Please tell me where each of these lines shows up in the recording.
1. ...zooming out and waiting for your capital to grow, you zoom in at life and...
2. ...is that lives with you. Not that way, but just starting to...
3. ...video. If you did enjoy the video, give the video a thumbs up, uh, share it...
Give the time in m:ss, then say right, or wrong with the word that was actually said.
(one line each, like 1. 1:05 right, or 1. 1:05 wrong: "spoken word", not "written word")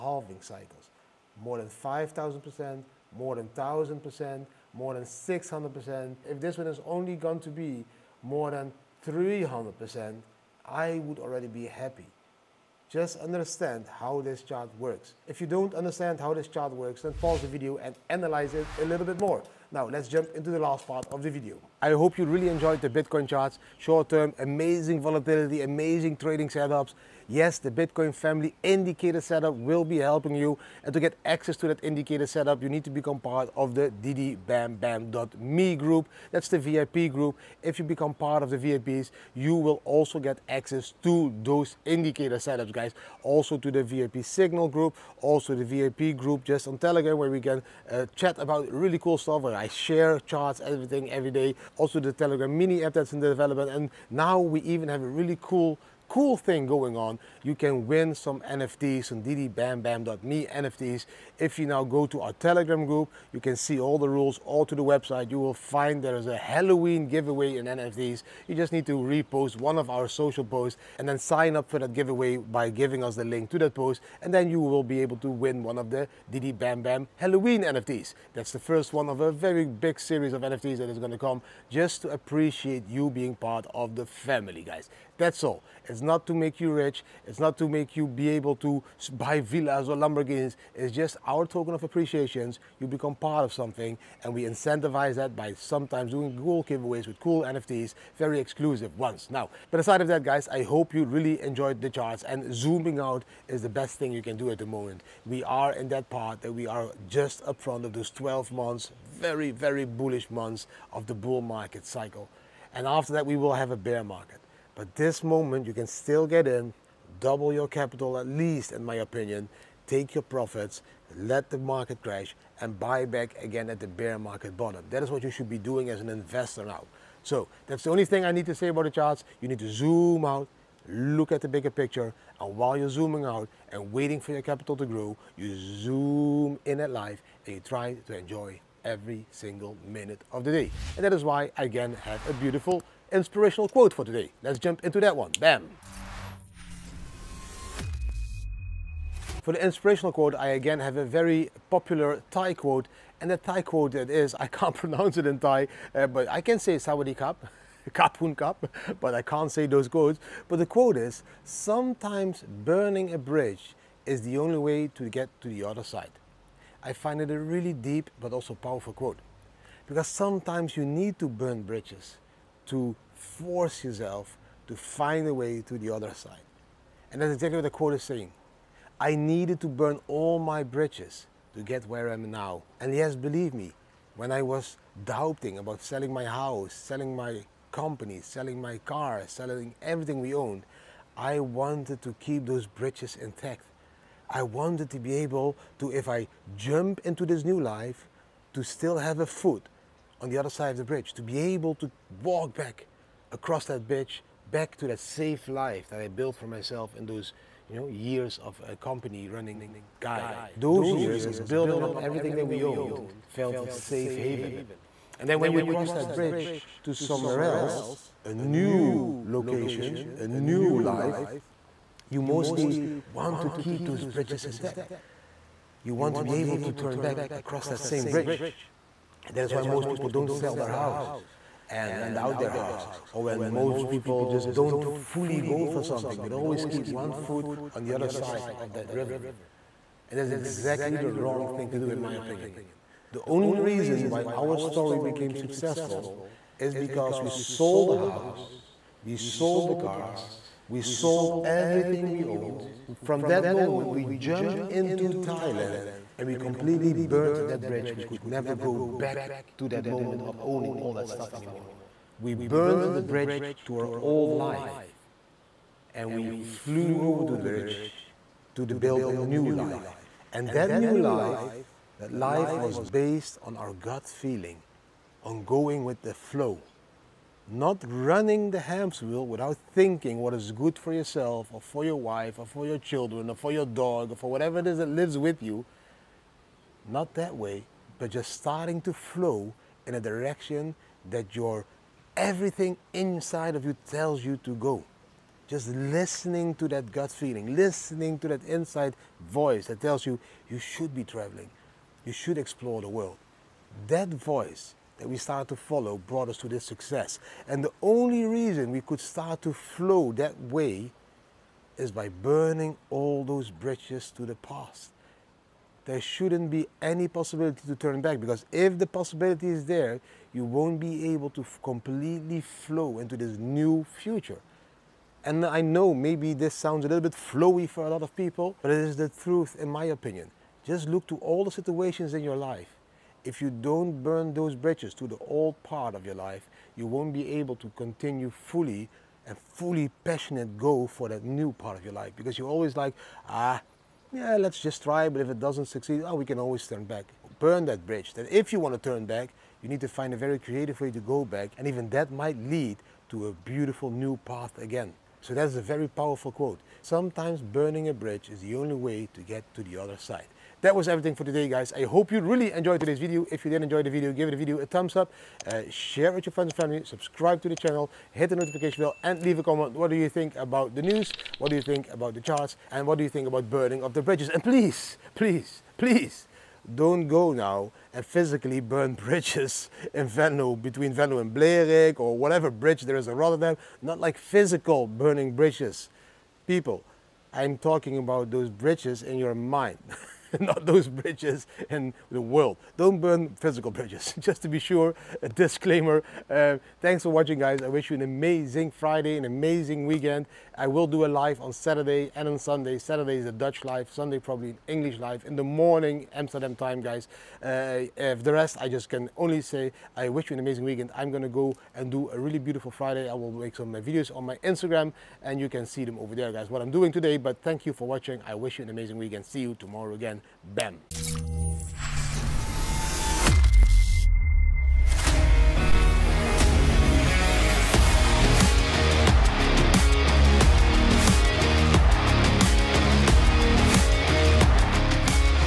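1. 2:12 right
2. 4:44 right
3. 6:02 right.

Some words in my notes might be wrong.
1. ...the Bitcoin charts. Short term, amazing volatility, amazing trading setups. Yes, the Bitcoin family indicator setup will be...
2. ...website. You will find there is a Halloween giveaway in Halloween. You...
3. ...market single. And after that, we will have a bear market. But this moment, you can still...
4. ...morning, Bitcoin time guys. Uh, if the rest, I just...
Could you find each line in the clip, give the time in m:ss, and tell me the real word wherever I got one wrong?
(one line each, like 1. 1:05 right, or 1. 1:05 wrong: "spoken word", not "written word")
1. 0:22 right
2. 1:04 wrong: "NFTs", not "Halloween"
3. 1:51 wrong: "cycle", not "single"
4. 6:45 wrong: "Amsterdam", not "Bitcoin".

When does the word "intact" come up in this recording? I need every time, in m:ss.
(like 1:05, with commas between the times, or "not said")
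3:13, 3:44.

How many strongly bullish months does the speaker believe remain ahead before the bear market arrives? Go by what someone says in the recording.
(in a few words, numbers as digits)
12.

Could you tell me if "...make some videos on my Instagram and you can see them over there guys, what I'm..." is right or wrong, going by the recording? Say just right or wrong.
right.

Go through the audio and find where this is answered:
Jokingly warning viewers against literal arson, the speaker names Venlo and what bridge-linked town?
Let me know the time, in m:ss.
6:21.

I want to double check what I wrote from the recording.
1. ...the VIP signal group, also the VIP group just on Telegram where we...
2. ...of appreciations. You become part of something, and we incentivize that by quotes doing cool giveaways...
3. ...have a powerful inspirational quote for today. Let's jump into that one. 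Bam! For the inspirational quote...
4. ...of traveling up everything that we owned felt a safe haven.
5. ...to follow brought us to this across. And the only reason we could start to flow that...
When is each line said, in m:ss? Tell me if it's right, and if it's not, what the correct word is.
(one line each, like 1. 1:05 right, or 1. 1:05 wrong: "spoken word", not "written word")
1. 0:43 right
2. 1:31 wrong: "sometimes", not "quotes"
3. 2:22 wrong: "beautiful", not "powerful"
4. 3:31 wrong: "building", not "traveling"
5. 5:05 wrong: "success", not "across".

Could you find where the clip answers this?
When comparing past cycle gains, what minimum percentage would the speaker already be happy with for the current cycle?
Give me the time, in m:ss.
0:09.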